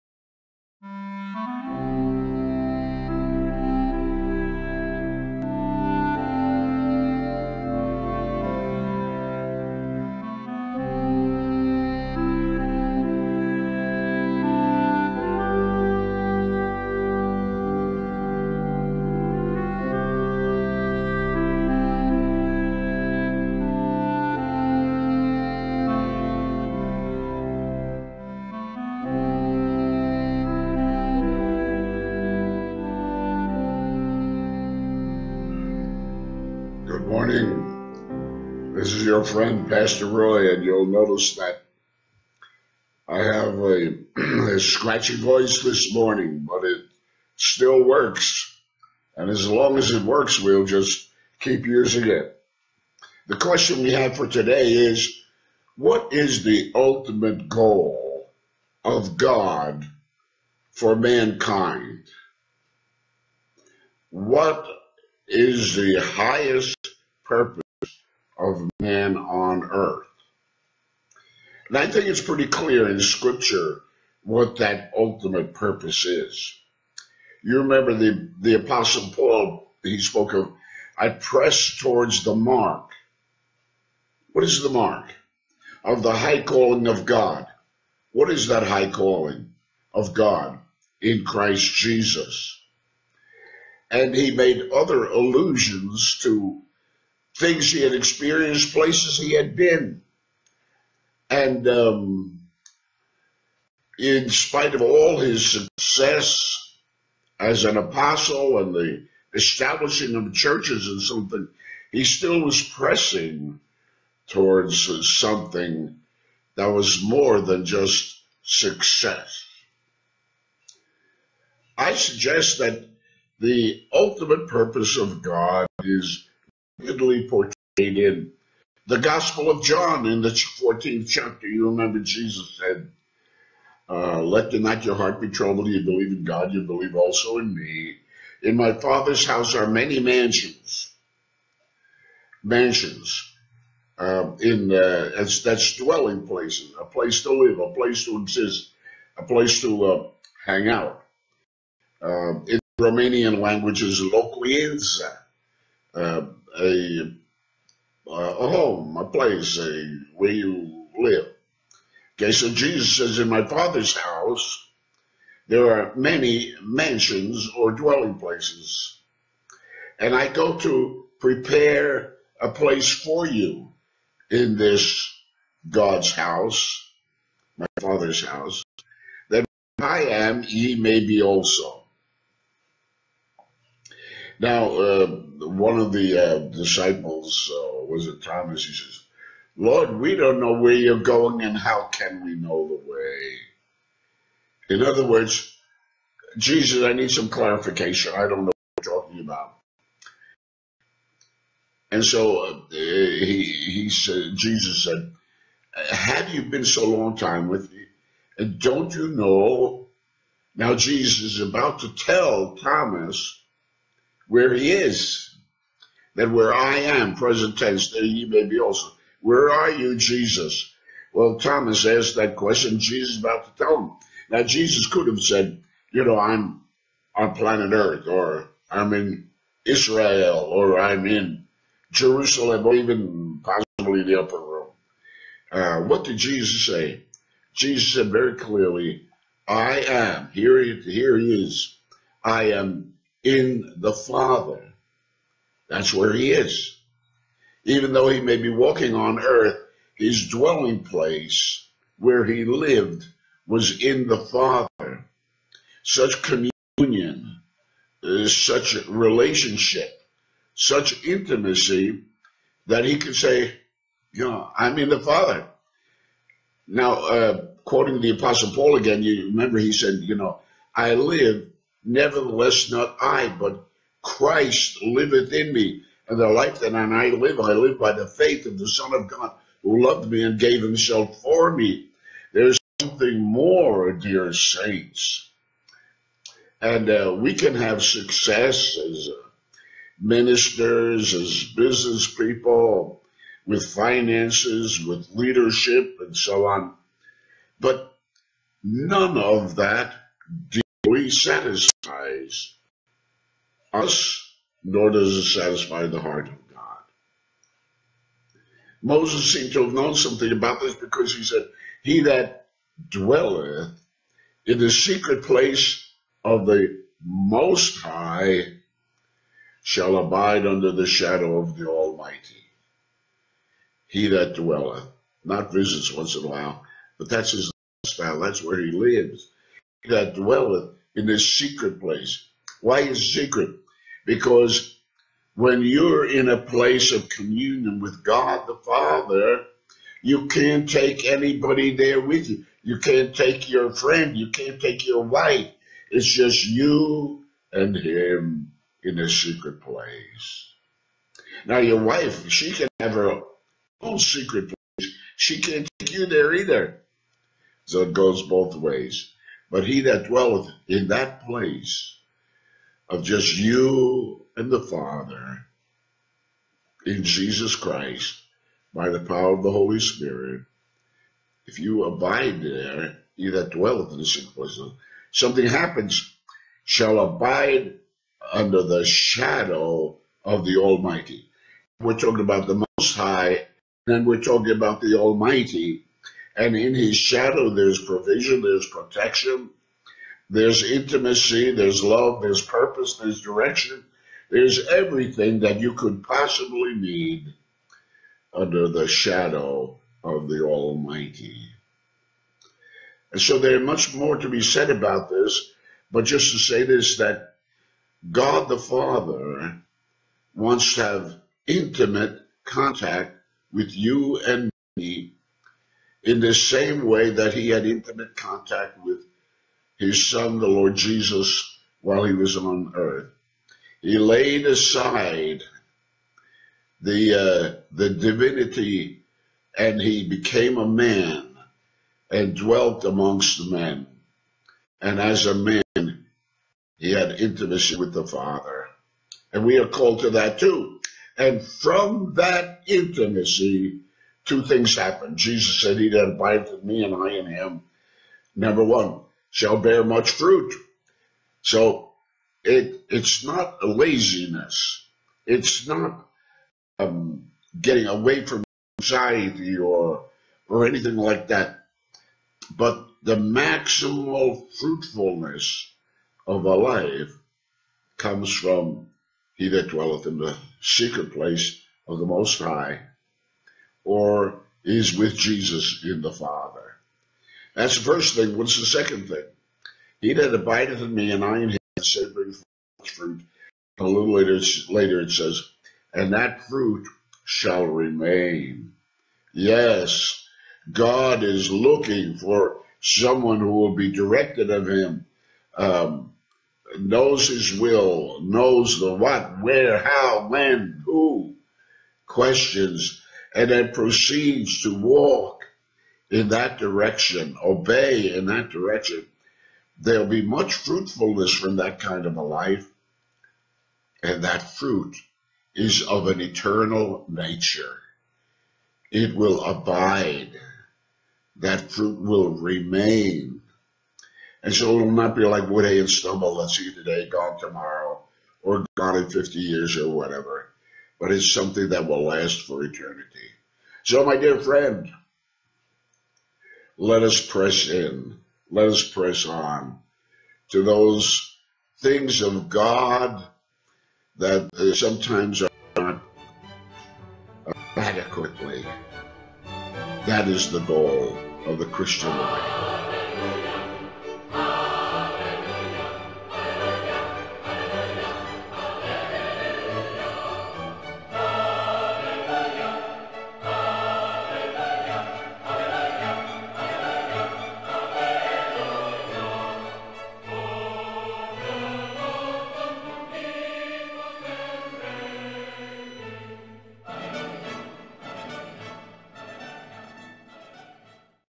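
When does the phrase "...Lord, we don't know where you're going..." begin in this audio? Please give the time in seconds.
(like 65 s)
189 s.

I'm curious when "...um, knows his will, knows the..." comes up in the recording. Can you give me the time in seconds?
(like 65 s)
495 s.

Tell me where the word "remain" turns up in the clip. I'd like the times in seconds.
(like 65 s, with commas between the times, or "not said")
487 s, 522 s.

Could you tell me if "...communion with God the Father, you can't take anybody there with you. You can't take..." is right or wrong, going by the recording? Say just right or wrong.
right.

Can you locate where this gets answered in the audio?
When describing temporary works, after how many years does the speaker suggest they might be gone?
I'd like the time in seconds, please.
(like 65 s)
529 s.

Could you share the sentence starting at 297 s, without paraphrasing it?
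But none of that satisfies us, nor does it satisfy the heart of God.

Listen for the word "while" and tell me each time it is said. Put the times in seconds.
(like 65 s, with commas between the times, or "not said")
326 s, 421 s.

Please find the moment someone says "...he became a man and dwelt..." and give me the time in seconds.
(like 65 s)
429 s.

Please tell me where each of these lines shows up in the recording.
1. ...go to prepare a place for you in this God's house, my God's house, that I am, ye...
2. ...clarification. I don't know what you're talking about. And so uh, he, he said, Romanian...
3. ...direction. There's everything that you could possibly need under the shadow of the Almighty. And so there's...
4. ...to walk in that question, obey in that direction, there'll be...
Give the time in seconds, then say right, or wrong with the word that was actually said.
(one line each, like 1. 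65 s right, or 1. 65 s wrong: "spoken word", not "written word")
1. 170 s wrong: "Father", not "God"
2. 197 s wrong: "Jesus", not "Romanian"
3. 393 s right
4. 504 s wrong: "direction", not "question".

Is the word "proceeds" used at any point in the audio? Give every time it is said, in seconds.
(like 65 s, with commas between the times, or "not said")
503 s.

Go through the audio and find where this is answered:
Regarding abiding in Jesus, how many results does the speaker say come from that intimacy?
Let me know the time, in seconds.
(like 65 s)
444 s.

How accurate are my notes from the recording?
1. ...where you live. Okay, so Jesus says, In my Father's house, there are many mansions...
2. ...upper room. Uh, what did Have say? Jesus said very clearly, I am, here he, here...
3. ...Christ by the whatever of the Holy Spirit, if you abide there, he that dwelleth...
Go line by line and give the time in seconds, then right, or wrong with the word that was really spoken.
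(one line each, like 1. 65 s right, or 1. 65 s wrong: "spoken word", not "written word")
1. 160 s right
2. 234 s wrong: "Jesus", not "Have"
3. 367 s wrong: "power", not "whatever".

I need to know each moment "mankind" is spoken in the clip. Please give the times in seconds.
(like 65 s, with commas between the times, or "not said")
60 s.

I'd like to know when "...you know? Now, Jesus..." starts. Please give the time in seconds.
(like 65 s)
208 s.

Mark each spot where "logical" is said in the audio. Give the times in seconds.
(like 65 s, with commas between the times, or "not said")
not said.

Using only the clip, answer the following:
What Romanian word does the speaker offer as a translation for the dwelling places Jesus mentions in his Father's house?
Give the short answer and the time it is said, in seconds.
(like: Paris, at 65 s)
locuința, at 154 s.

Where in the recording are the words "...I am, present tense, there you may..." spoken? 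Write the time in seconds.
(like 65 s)
216 s.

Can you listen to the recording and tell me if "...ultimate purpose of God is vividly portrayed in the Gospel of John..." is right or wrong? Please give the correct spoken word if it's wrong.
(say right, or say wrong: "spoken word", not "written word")
right.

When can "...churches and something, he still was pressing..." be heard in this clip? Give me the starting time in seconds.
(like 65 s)
110 s.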